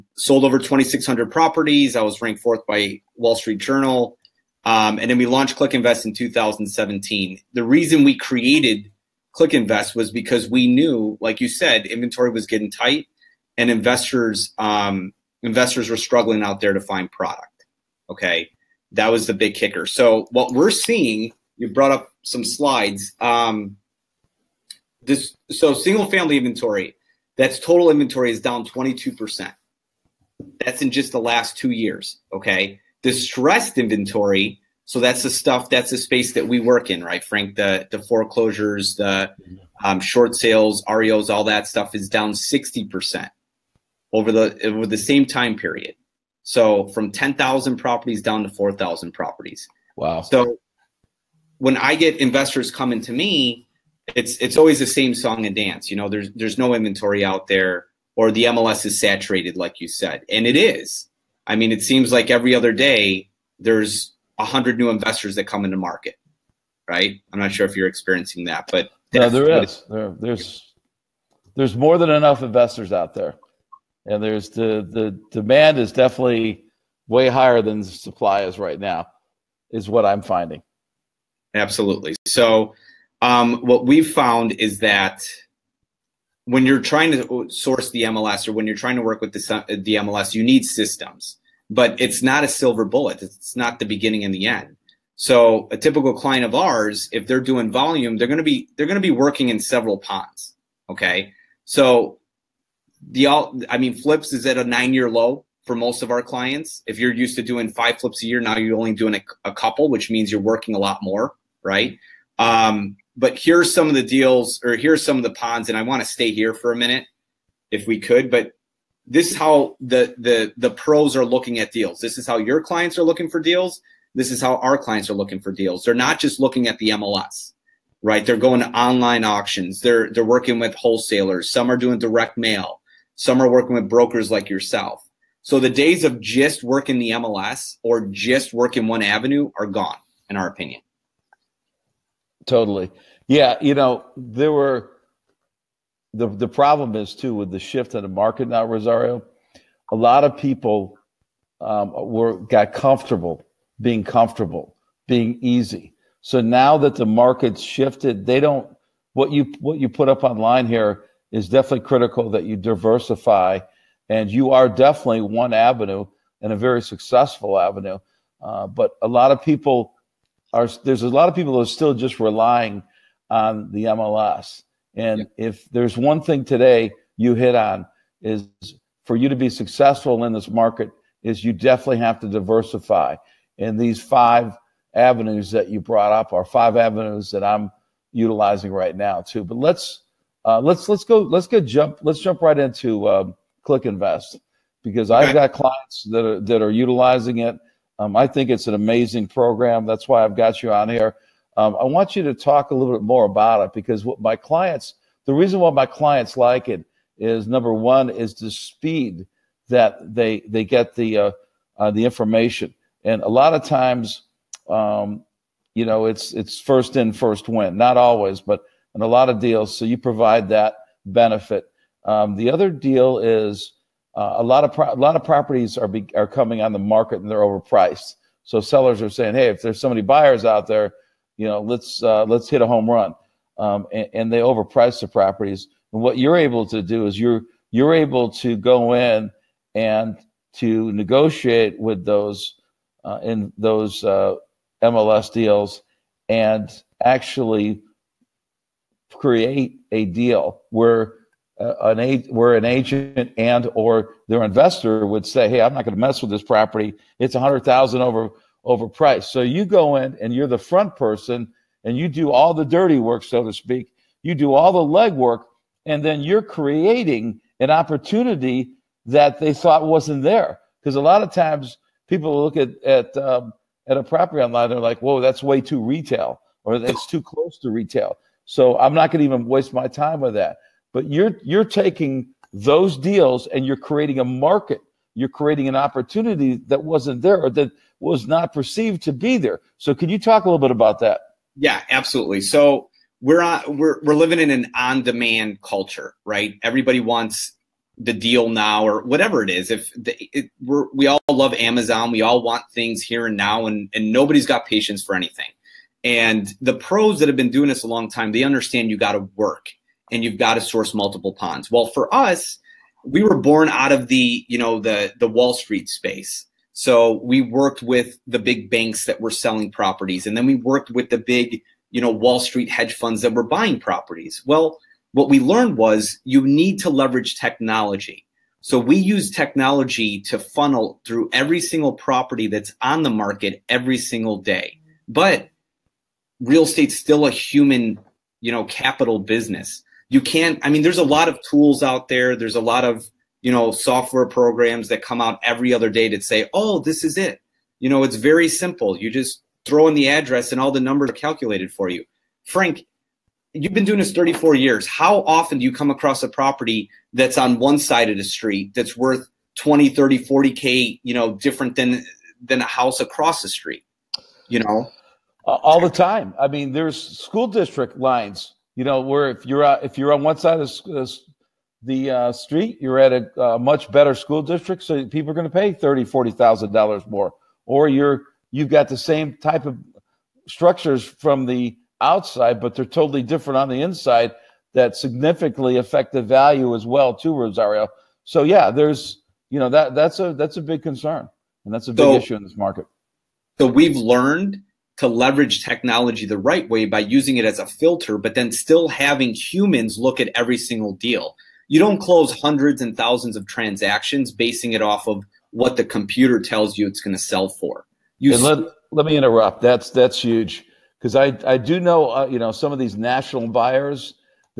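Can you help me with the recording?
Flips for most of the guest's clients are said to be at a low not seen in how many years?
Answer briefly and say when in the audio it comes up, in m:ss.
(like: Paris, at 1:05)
9 years, at 1:44.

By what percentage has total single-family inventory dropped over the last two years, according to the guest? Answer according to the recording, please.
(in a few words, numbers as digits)
22%.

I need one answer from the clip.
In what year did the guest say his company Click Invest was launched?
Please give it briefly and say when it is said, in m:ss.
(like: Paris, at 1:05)
2017, at 0:06.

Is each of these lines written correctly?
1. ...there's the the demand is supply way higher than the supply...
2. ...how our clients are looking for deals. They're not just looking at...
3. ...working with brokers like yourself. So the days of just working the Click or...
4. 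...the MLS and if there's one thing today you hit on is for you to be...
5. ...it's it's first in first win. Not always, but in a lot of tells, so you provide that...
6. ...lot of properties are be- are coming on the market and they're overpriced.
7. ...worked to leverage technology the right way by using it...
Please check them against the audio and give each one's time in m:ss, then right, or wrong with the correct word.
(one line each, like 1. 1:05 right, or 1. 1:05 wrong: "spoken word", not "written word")
1. 1:14 wrong: "definitely", not "supply"
2. 2:04 right
3. 2:13 wrong: "MLS", not "Click"
4. 2:53 right
5. 3:36 wrong: "deals", not "tells"
6. 3:44 right
7. 6:33 wrong: "learned", not "worked".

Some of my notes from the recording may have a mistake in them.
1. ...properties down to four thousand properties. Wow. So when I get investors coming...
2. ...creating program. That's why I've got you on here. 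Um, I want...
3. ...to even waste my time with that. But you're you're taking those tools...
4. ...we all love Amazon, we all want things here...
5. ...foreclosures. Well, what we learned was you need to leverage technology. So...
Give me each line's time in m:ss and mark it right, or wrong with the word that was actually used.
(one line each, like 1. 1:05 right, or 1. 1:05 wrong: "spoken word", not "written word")
1. 0:47 right
2. 3:18 wrong: "amazing", not "creating"
3. 4:39 wrong: "deals", not "tools"
4. 5:00 right
5. 5:23 wrong: "properties", not "foreclosures".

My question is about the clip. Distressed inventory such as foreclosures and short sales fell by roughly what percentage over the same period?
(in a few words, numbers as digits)
60%.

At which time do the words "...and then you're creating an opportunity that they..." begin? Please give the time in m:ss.
4:25.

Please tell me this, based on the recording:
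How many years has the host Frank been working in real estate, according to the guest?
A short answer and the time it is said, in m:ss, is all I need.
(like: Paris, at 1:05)
34 years, at 5:54.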